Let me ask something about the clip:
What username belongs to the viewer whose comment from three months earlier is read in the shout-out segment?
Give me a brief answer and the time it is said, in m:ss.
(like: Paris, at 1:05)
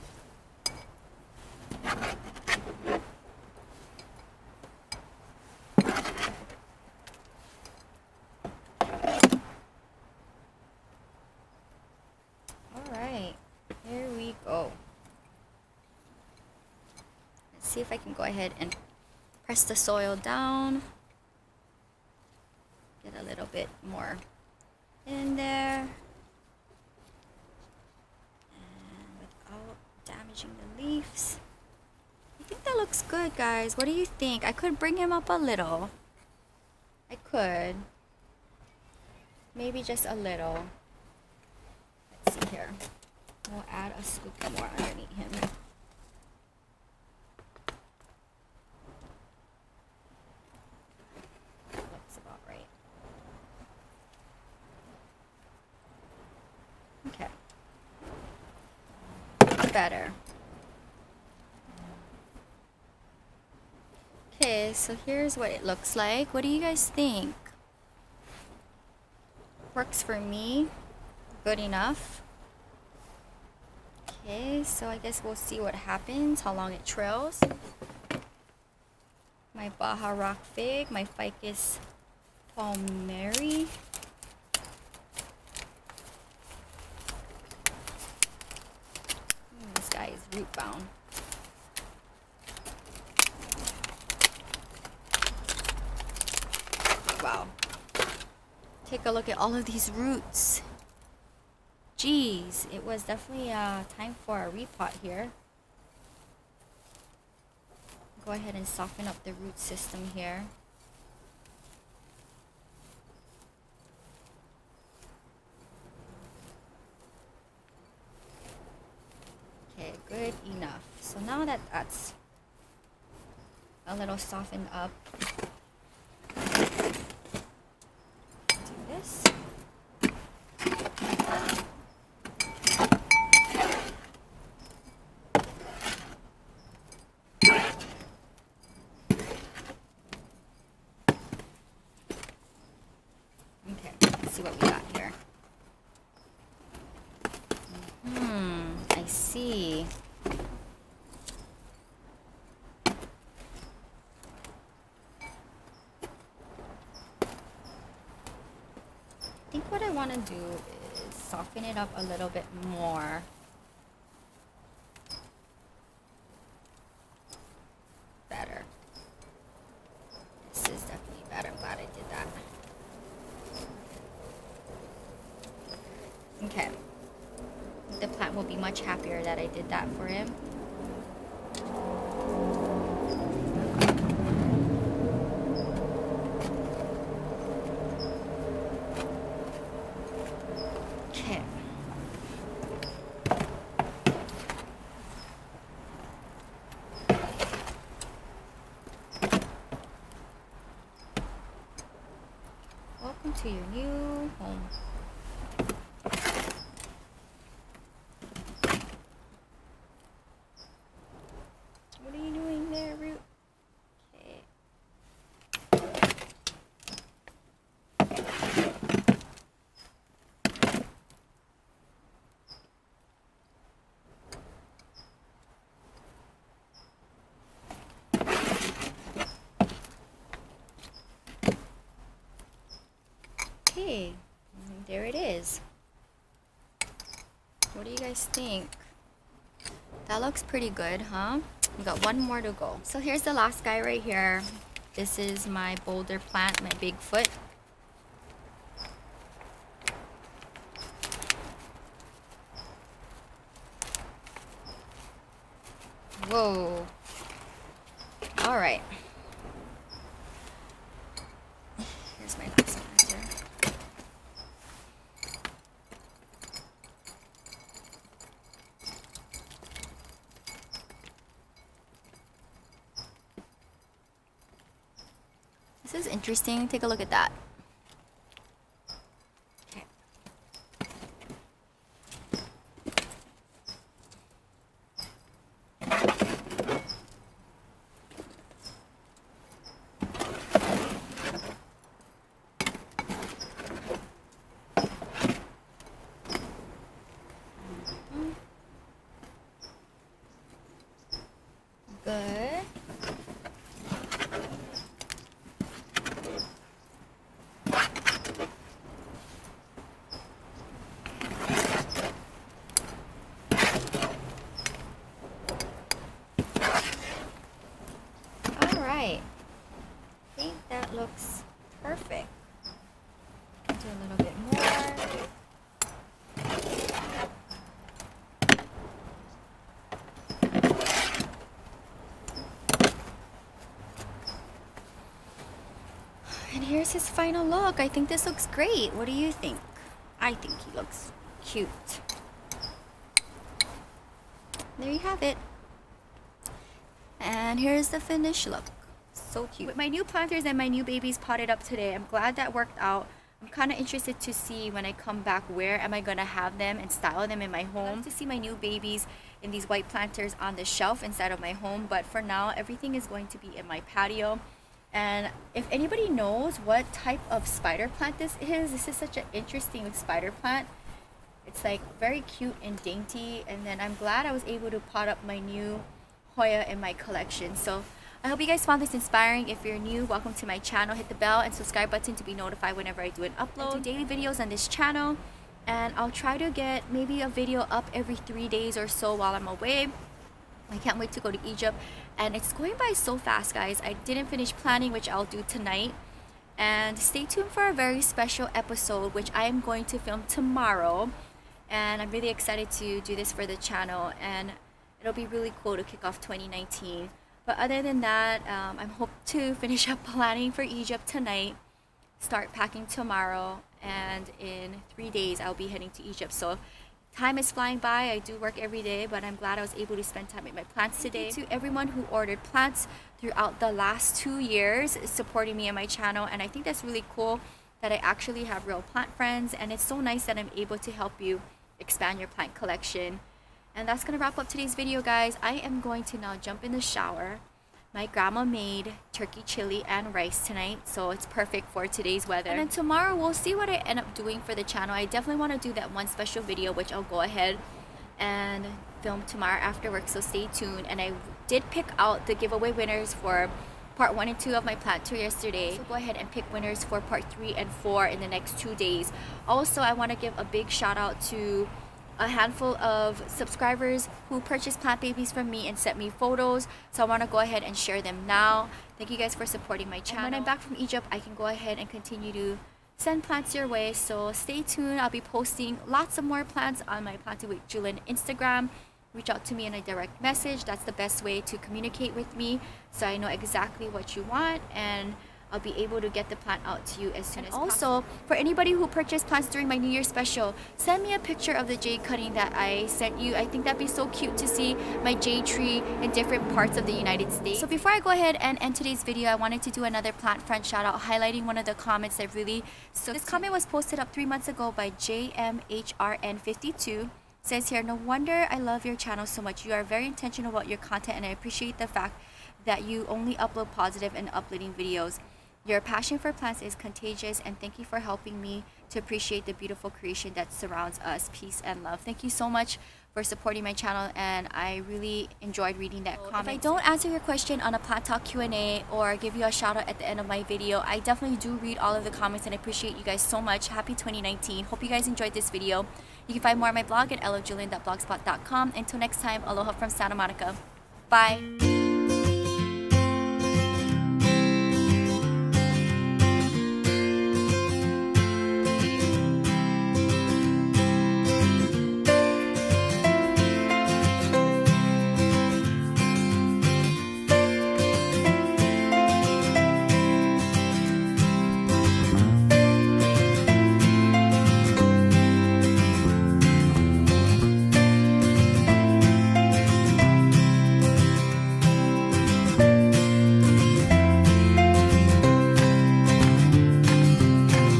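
JMHRN52, at 8:24.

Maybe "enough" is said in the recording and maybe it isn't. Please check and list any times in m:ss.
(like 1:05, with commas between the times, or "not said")
1:11, 2:00.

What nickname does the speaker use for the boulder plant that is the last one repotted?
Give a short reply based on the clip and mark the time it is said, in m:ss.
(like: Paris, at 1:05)
Bigfoot, at 4:06.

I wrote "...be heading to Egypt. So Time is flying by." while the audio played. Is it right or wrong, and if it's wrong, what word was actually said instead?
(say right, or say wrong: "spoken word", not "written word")
right.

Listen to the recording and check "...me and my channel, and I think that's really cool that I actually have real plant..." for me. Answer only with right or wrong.
right.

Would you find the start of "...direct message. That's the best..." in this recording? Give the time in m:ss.
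7:59.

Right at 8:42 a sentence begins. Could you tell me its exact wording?
Thank you so much for supporting my channel, and I really enjoyed reading that comment.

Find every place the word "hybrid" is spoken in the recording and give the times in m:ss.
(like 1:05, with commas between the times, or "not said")
not said.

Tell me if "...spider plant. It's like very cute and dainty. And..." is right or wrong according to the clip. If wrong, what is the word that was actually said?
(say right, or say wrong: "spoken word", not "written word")
right.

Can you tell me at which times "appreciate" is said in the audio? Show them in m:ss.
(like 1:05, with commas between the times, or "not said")
8:31, 8:38, 8:52.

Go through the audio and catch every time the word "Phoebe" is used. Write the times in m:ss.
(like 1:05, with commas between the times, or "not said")
not said.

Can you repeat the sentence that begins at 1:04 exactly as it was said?
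so here's what it looks like.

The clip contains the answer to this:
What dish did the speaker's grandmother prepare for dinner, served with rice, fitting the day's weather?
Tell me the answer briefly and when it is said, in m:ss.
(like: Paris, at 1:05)
Turkey chili, at 7:19.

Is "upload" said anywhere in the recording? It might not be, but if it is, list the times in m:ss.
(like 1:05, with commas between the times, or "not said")
6:23, 8:33.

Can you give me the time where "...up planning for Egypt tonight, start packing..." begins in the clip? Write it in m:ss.
6:49.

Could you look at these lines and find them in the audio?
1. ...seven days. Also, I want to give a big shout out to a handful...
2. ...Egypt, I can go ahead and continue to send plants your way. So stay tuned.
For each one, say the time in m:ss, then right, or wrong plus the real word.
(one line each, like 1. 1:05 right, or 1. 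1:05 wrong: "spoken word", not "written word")
1. 7:38 wrong: "two", not "seven"
2. 7:50 right.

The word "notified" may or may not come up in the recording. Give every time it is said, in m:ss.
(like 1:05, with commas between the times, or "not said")
6:22.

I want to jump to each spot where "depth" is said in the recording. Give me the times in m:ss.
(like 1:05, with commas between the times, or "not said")
not said.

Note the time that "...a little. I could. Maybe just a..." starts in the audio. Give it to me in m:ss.
0:35.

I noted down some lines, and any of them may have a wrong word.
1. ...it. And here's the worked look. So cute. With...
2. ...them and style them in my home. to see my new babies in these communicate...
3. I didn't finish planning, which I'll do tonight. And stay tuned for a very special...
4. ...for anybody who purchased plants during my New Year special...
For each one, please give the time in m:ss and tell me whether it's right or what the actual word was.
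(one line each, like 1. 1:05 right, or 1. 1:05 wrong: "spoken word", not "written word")
1. 5:45 wrong: "finished", not "worked"
2. 5:56 wrong: "white", not "communicate"
3. 6:33 right
4. 8:08 right.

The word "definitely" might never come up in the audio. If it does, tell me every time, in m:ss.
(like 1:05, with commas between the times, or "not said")
1:43, 7:25, 8:51.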